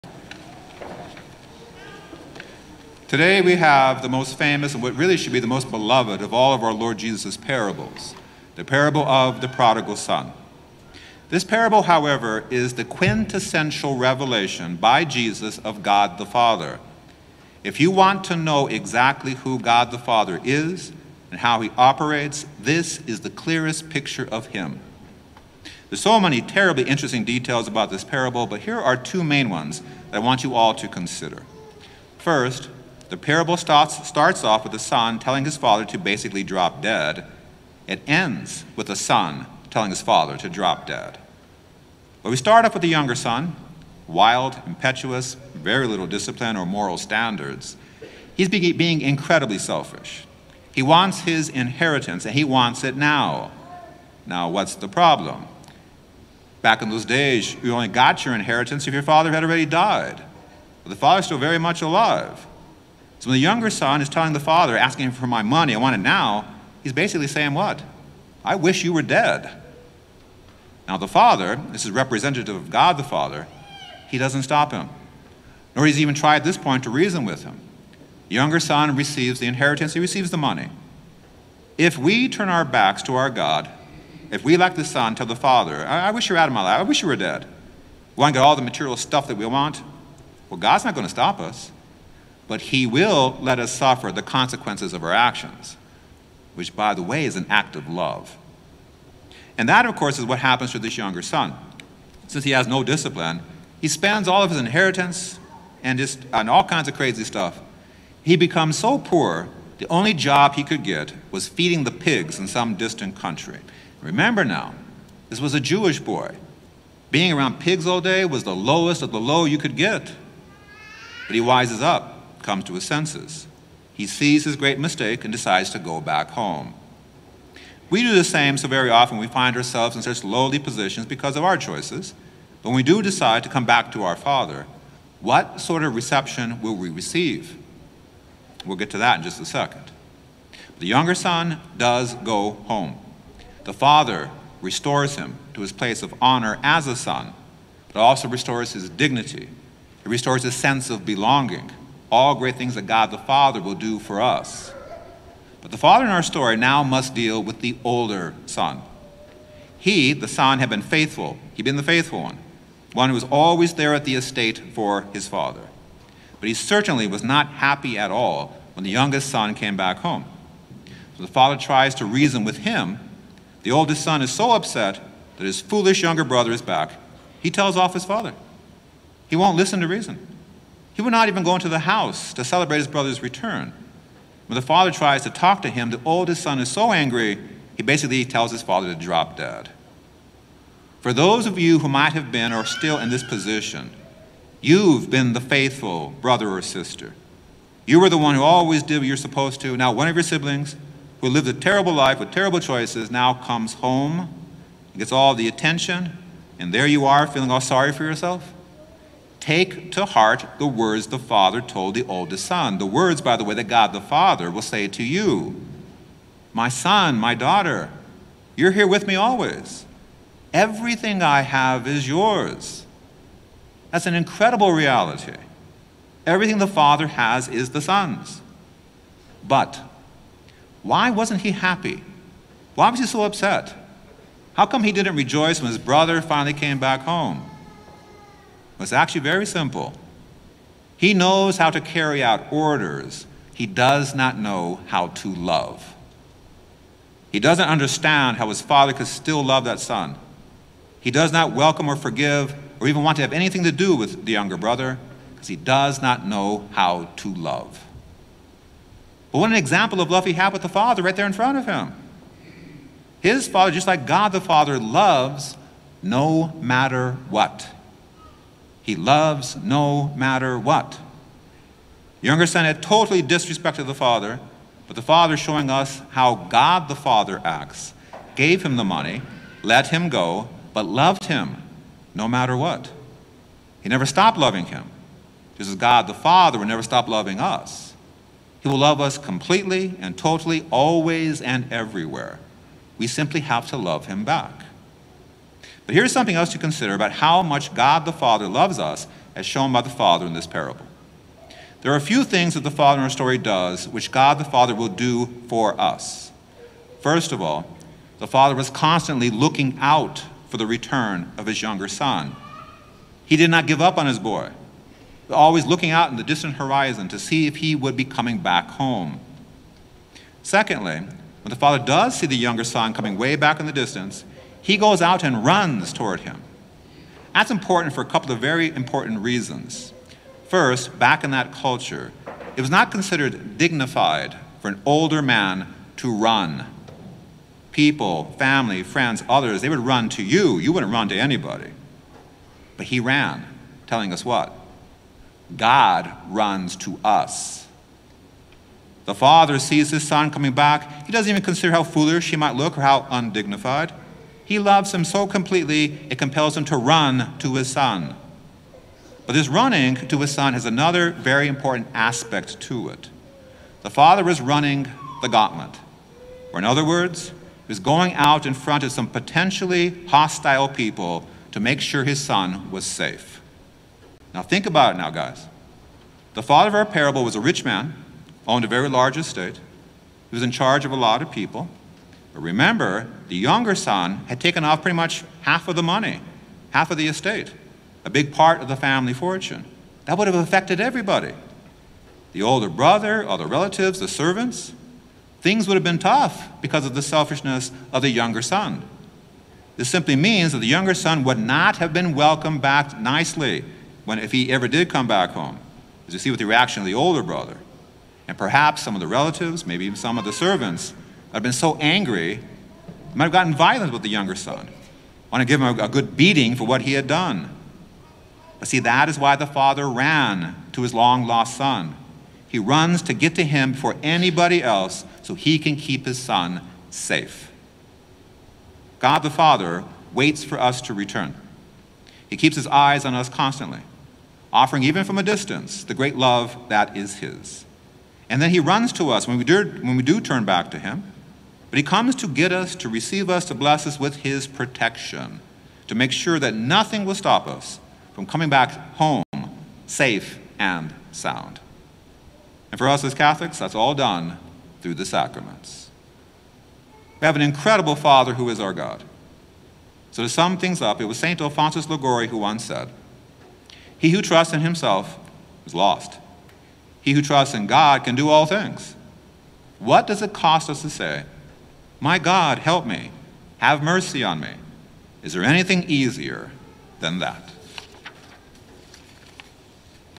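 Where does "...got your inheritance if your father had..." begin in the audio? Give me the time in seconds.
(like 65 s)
57 s.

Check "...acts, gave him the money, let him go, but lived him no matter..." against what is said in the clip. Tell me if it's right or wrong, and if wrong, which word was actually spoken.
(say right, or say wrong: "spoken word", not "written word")
wrong: "loved", not "lived".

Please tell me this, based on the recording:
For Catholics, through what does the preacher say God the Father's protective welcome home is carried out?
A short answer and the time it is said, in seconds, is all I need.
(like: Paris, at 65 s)
the sacraments, at 454 s.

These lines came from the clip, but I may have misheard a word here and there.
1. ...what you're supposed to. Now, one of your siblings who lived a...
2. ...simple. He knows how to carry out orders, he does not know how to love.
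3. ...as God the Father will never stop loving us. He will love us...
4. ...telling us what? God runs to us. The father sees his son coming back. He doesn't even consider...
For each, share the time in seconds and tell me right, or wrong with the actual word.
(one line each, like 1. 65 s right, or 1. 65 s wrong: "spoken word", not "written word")
1. 198 s right
2. 239 s right
3. 285 s right
4. 343 s right.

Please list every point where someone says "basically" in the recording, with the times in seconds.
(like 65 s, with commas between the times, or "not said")
35 s, 66 s, 187 s.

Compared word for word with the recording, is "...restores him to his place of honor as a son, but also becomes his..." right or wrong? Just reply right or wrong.
wrong.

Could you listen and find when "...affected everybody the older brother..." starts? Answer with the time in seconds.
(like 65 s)
390 s.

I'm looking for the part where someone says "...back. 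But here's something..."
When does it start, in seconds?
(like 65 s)
294 s.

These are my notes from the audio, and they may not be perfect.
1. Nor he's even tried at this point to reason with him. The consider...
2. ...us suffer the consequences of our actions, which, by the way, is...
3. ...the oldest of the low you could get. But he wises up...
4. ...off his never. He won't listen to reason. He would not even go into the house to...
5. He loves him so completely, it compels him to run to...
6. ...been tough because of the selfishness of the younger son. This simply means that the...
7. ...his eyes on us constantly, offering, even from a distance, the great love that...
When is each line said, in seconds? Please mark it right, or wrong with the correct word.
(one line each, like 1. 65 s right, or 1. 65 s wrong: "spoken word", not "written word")
1. 75 s wrong: "younger", not "consider"
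2. 93 s right
3. 118 s wrong: "lowest", not "oldest"
4. 177 s wrong: "father", not "never"
5. 354 s right
6. 395 s right
7. 432 s right.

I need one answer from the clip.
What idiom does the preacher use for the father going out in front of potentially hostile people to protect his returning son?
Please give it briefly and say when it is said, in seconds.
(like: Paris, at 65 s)
running the gauntlet, at 364 s.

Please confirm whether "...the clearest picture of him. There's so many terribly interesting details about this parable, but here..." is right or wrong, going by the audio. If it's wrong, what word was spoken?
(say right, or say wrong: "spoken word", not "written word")
right.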